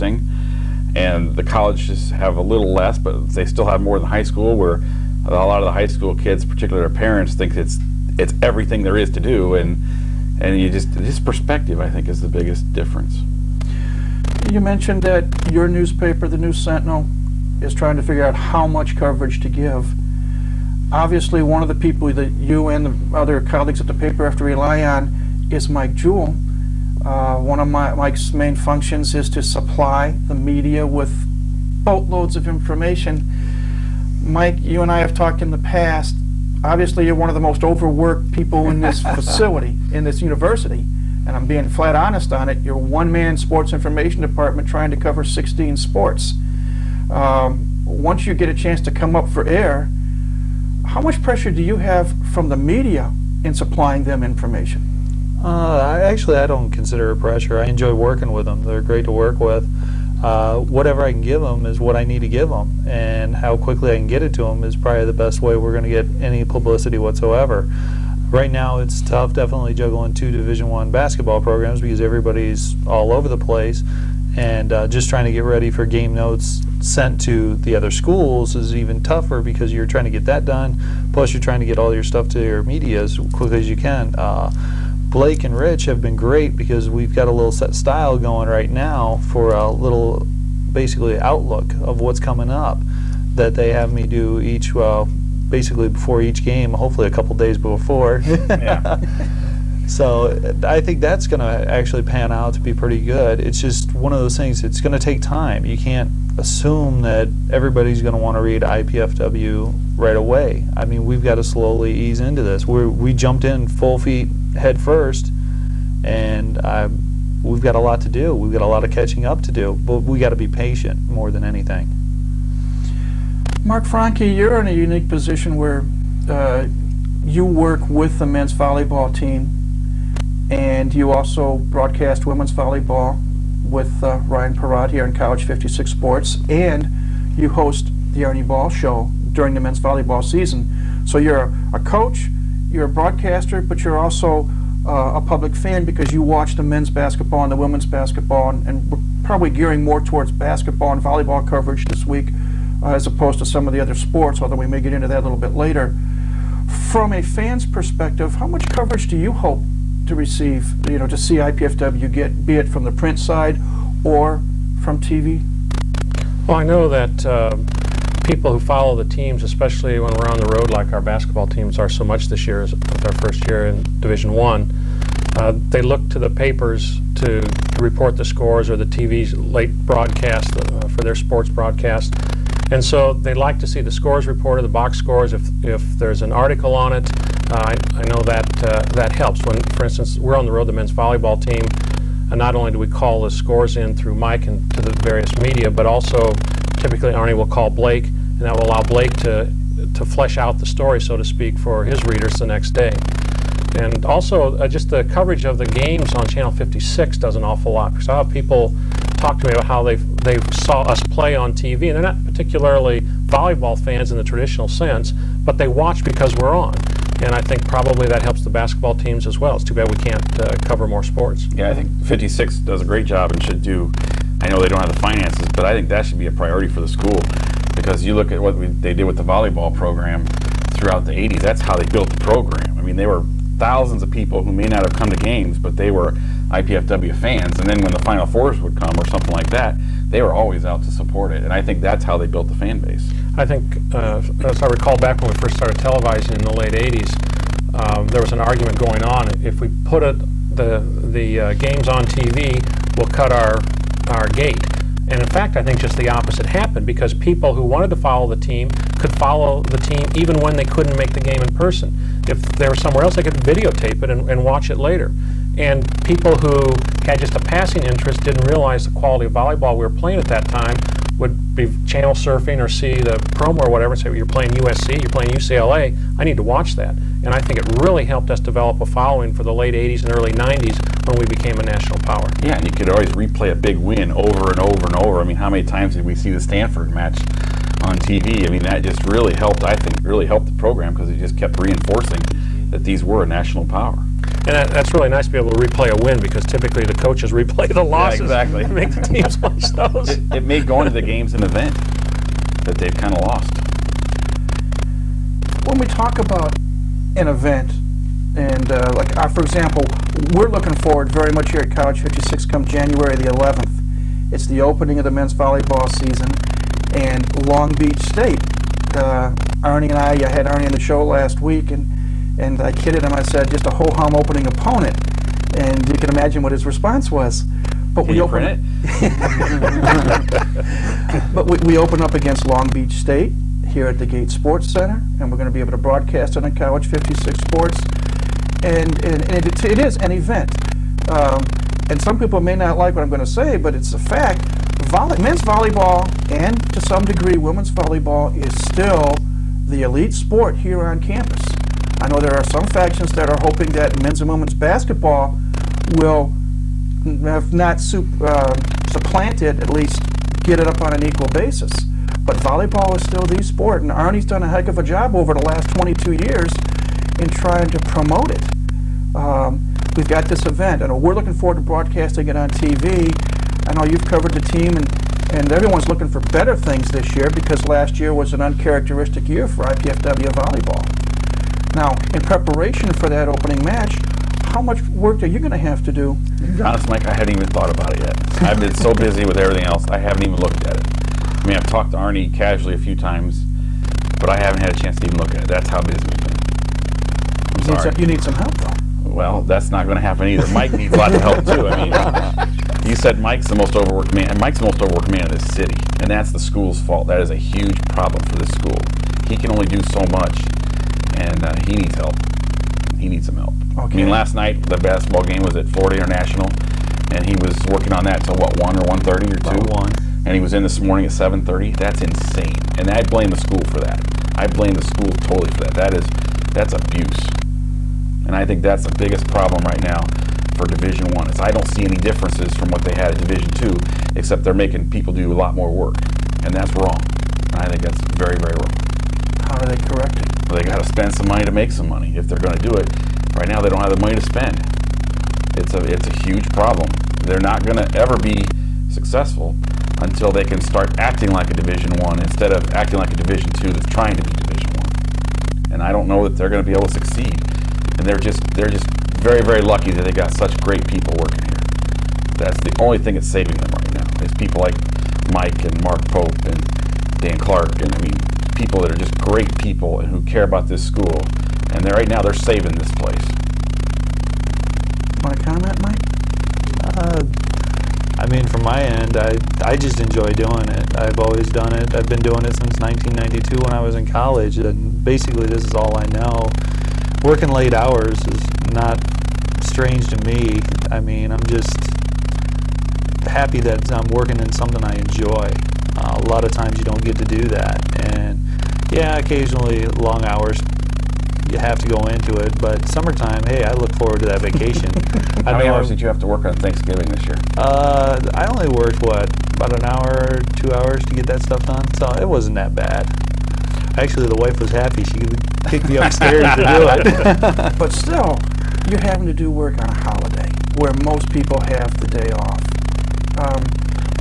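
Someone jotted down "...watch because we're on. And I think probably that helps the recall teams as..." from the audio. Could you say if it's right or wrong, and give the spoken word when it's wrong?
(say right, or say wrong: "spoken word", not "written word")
wrong: "basketball", not "recall".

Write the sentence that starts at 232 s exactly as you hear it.
I mean, they were thousands of people who may not have come to games, but they were IPFW fans.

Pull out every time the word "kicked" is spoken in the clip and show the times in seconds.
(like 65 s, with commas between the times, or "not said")
515 s.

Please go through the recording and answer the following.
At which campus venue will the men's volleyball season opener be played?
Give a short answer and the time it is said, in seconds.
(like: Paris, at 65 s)
Gates Sports Center, at 334 s.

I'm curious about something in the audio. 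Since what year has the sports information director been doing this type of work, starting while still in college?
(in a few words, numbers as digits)
1992.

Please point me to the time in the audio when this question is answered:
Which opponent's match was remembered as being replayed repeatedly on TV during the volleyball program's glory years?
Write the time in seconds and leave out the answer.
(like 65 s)
286 s.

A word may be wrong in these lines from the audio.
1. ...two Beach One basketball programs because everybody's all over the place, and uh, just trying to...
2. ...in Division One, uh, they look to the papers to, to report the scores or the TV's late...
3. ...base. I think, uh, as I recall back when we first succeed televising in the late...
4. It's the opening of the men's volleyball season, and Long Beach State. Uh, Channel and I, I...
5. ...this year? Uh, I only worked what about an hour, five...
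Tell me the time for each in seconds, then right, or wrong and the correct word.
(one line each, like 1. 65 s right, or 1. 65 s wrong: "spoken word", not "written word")
1. 70 s wrong: "Division", not "Beach"
2. 173 s right
3. 242 s wrong: "started", not "succeed"
4. 314 s wrong: "Arnie", not "Channel"
5. 507 s wrong: "two", not "five".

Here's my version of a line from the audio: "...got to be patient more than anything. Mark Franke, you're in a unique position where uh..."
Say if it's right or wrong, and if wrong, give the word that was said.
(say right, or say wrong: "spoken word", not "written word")
right.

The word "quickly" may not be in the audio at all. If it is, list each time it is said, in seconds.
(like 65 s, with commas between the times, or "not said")
63 s, 83 s.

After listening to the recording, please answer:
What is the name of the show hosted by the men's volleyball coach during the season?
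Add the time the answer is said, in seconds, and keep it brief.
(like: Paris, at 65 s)
Arnie Ball Show, at 138 s.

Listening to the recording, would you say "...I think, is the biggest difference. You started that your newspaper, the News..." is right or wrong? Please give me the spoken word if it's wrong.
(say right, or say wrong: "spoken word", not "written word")
wrong: "mentioned", not "started".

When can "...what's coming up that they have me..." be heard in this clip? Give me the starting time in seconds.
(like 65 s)
91 s.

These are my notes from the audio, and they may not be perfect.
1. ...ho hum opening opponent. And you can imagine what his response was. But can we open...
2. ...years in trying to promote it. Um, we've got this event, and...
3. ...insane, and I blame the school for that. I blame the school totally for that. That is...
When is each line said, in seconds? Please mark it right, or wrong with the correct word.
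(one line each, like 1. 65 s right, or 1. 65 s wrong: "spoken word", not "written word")
1. 323 s right
2. 366 s right
3. 422 s right.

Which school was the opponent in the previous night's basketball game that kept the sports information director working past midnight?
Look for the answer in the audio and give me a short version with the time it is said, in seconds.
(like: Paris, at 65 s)
Florida International, at 415 s.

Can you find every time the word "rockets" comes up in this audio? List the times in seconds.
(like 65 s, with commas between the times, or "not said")
not said.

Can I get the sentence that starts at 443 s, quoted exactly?
Right now, they don't have the money to spend.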